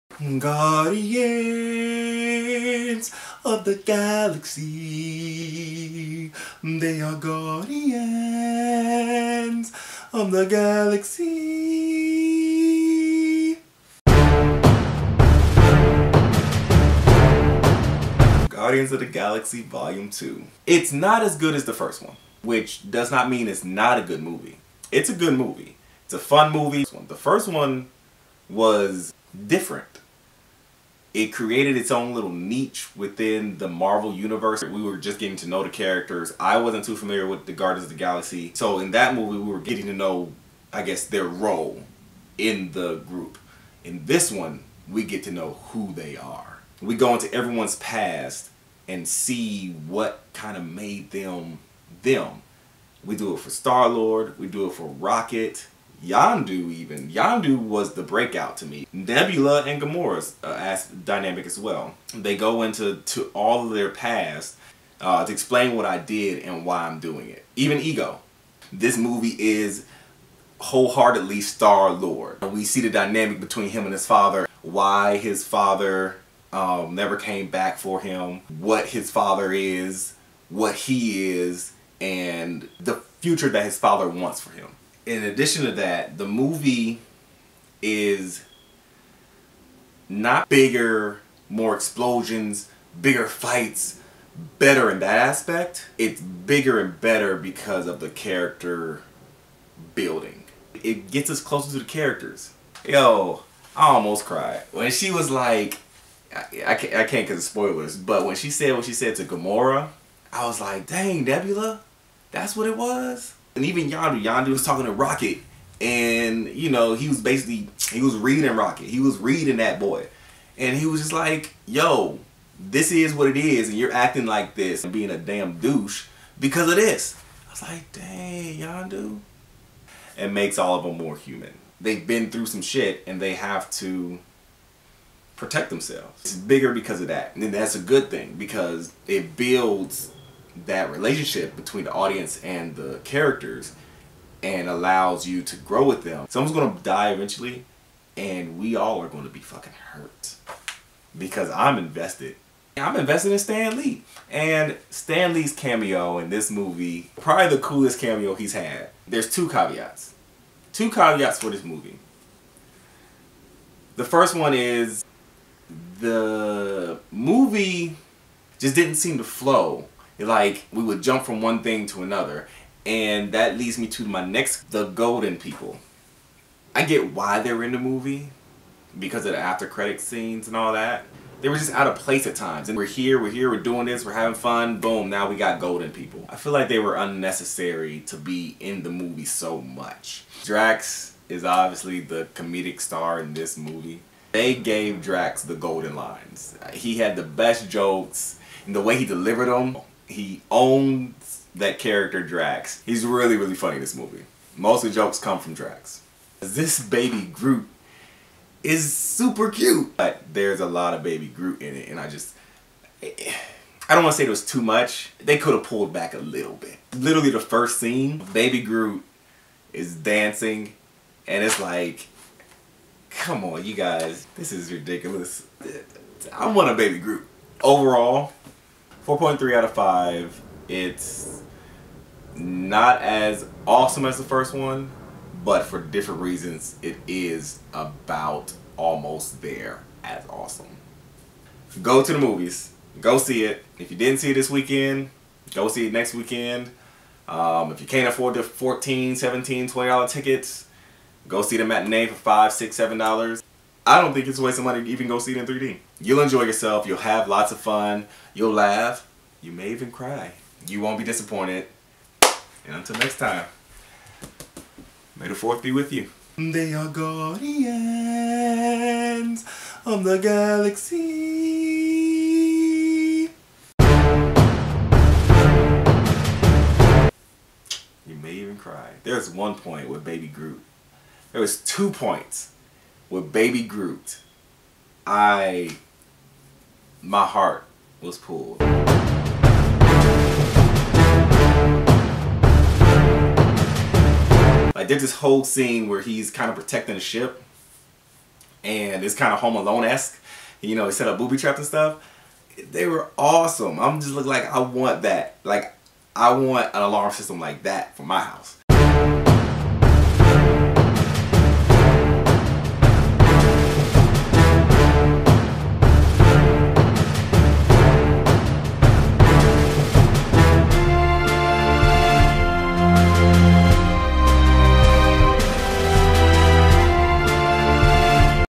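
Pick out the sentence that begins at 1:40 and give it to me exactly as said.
It gets us closer to the characters.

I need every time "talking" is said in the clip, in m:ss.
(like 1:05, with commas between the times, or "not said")
1:54.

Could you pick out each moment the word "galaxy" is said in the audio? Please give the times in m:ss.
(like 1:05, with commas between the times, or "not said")
0:03, 0:10, 0:19, 0:37, 4:30.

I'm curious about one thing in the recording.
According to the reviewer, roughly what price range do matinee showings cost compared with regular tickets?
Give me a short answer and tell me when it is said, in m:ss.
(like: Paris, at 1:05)
$5 to $7, at 4:12.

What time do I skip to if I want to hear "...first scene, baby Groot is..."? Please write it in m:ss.
3:37.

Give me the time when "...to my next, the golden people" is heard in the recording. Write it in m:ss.
2:53.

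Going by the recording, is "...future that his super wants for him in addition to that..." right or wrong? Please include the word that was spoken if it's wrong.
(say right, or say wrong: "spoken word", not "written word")
wrong: "father", not "super".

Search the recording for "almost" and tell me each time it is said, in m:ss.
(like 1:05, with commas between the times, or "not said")
1:43, 3:58.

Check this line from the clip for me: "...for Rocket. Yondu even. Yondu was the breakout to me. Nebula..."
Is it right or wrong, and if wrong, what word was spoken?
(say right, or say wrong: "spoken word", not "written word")
right.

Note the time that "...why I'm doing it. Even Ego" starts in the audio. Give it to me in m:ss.
1:06.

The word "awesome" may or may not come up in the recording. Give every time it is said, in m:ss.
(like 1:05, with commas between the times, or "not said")
3:53, 4:00, 5:03.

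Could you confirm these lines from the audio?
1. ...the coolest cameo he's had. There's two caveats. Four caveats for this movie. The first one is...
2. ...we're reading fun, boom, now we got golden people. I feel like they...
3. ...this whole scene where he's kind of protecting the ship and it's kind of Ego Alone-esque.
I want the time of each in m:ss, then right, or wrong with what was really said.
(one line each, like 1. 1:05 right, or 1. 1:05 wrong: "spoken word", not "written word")
1. 2:37 wrong: "Two", not "Four"
2. 3:04 wrong: "having", not "reading"
3. 4:55 wrong: "Home", not "Ego".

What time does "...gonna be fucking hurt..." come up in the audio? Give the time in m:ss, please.
2:29.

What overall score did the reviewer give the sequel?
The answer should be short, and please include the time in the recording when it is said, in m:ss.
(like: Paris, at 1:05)
4.3 out of 5, at 3:49.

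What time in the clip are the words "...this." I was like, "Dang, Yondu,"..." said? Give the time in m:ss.
2:06.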